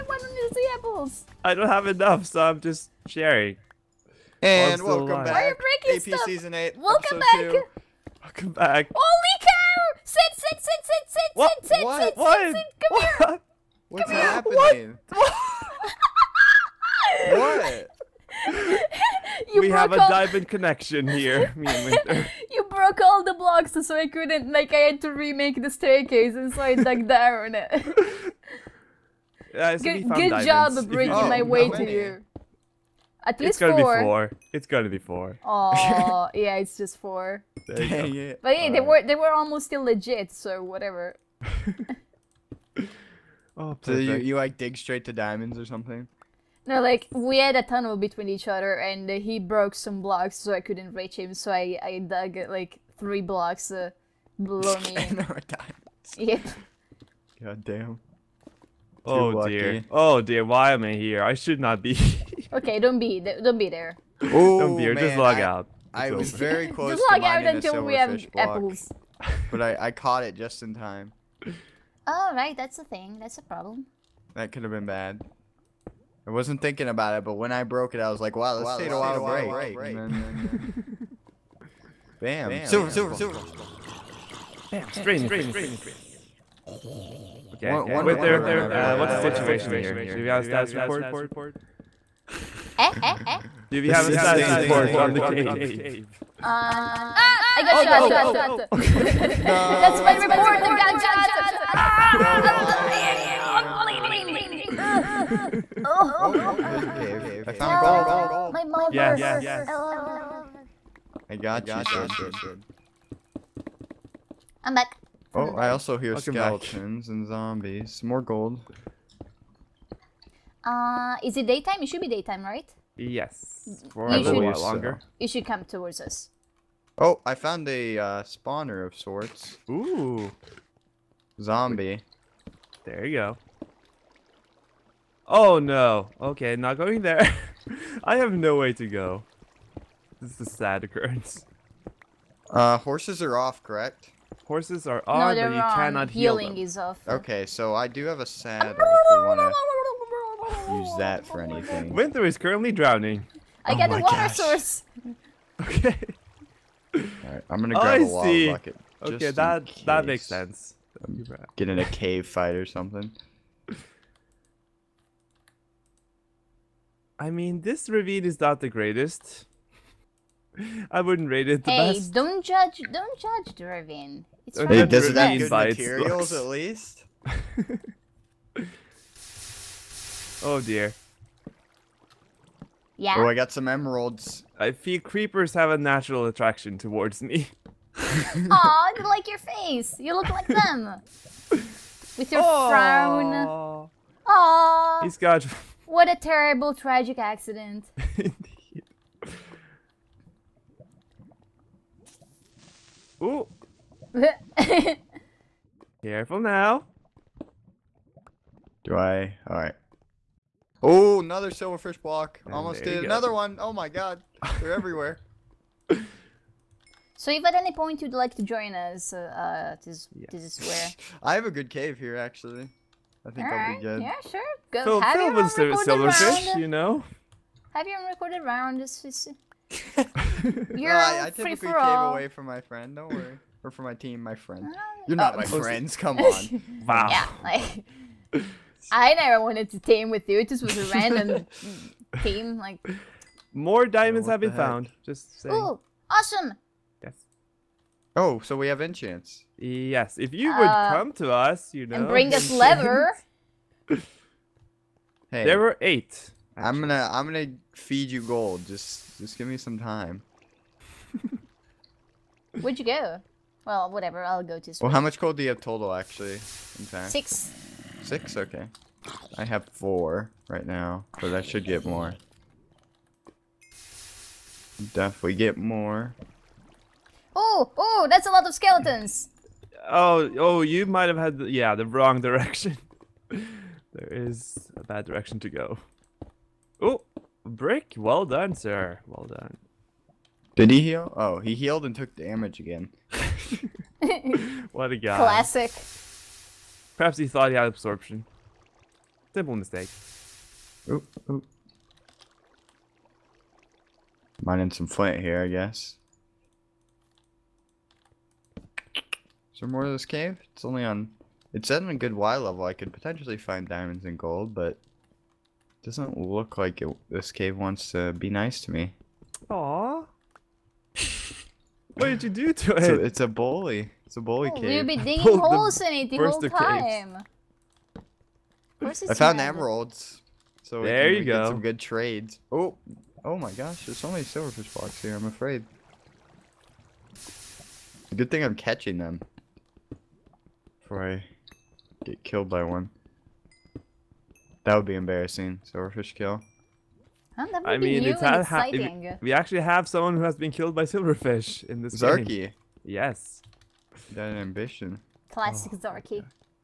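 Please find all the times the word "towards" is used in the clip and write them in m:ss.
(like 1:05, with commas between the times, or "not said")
2:05, 3:06.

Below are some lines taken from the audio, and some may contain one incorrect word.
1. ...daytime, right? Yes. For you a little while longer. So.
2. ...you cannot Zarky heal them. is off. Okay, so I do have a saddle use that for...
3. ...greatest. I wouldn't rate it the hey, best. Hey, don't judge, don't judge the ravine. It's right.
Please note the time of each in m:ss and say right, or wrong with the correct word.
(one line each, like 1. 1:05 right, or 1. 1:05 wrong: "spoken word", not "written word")
1. 2:02 right
2. 2:25 wrong: "Healing", not "Zarky"
3. 2:48 right.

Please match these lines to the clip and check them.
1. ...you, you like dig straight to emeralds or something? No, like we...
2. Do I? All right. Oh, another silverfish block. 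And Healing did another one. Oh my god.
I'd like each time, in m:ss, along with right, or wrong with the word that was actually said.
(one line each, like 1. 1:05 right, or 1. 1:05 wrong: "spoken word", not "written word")
1. 0:43 wrong: "diamonds", not "emeralds"
2. 3:28 wrong: "Almost", not "Healing".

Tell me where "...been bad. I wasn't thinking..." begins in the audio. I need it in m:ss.
1:14.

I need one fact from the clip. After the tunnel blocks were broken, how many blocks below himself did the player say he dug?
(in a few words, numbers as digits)
3.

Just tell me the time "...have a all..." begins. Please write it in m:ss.
0:19.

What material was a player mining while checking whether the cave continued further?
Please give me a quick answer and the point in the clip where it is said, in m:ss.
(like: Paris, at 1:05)
Flint, at 5:04.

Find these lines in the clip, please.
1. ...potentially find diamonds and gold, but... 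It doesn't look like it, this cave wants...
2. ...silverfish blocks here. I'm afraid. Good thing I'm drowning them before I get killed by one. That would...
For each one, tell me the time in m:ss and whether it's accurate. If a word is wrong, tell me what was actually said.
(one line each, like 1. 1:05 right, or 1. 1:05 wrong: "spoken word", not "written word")
1. 5:12 right
2. 5:34 wrong: "catching", not "drowning".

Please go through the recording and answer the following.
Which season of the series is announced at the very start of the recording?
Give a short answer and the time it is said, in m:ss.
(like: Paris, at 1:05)
Season 8, at 0:06.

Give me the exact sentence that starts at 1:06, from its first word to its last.
just log out until we have block, apples.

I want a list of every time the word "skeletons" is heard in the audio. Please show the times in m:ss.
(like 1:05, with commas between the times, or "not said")
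1:56, 4:38.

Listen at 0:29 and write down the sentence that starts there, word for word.
Yeah, so good, good job bringing oh, my way to you.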